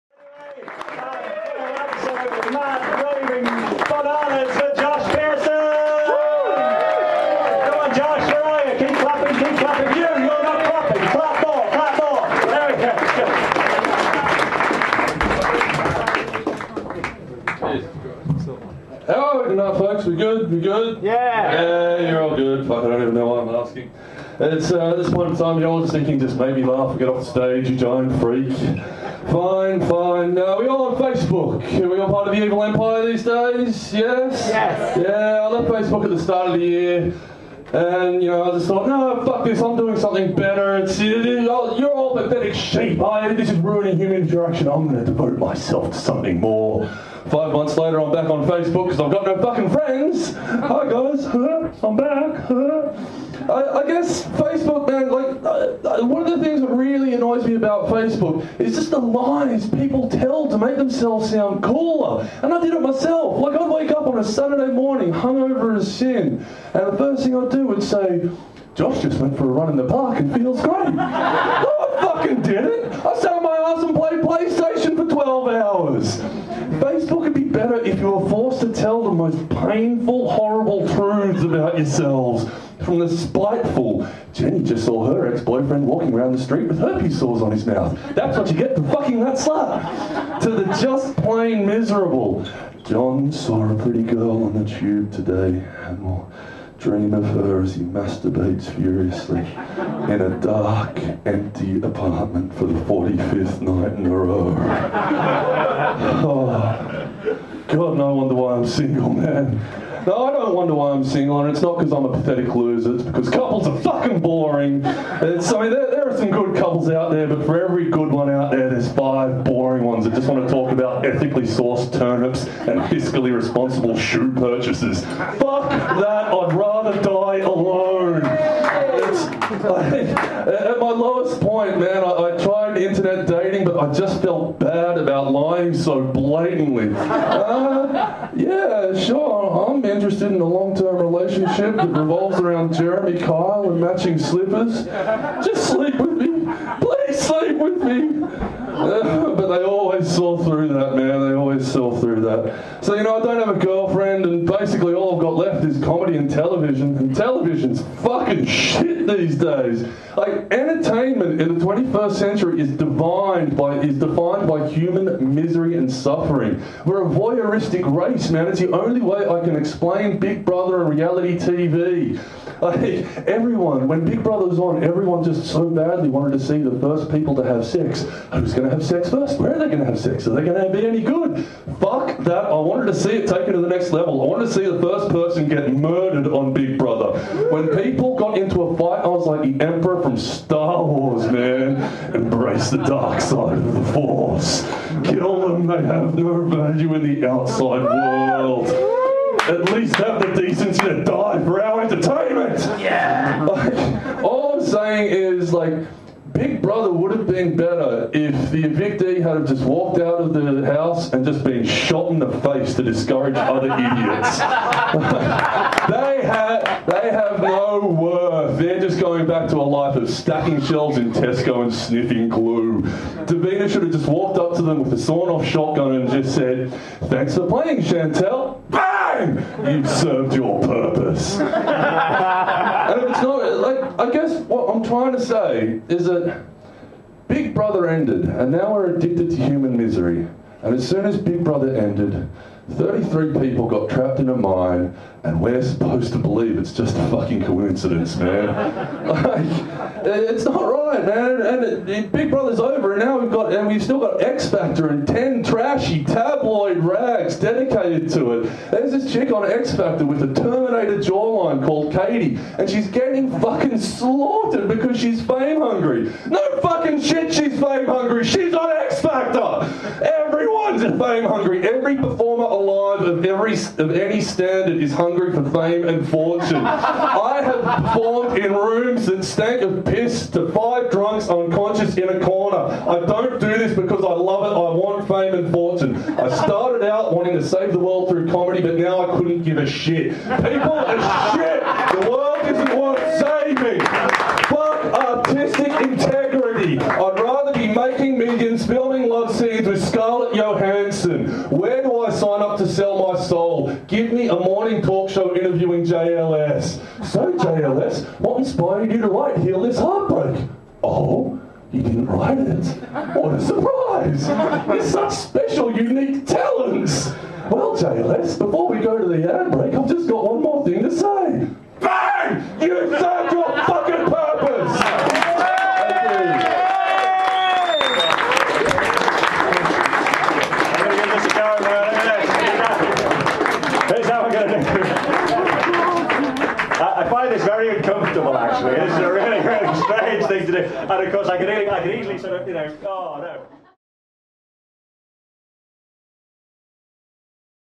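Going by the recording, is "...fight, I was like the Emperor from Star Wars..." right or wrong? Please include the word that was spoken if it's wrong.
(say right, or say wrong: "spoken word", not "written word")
right.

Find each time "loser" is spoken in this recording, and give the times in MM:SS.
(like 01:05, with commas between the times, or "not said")
01:52.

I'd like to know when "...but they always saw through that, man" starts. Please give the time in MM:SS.
02:29.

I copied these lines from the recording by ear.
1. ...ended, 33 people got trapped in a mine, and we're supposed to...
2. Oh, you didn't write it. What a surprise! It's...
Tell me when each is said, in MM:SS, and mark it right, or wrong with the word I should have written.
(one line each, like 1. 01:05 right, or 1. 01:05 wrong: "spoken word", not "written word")
1. 04:01 right
2. 05:10 right.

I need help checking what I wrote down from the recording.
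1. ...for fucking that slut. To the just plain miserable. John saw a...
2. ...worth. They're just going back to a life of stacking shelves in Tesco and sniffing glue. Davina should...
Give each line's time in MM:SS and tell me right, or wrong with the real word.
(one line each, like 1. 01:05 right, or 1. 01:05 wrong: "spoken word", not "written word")
1. 01:28 right
2. 03:37 right.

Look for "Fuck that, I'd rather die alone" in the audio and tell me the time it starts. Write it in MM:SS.
02:05.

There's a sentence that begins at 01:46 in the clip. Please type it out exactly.
Oh, God, no wonder why I'm single, man.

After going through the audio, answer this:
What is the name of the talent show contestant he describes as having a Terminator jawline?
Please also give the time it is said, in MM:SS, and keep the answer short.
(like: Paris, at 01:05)
Katie, at 04:21.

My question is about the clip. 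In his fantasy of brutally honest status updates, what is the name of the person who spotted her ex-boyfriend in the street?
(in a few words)
Jenny.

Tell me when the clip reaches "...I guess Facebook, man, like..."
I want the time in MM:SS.
00:53.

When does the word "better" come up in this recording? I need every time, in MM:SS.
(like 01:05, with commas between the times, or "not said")
00:40, 01:17, 03:27.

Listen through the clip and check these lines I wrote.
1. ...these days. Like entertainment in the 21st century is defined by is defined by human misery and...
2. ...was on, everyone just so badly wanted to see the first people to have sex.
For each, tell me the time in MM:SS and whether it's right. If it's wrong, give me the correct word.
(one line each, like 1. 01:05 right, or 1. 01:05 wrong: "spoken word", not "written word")
1. 02:39 right
2. 02:54 right.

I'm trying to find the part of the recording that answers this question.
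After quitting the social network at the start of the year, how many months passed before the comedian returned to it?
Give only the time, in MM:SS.
00:47.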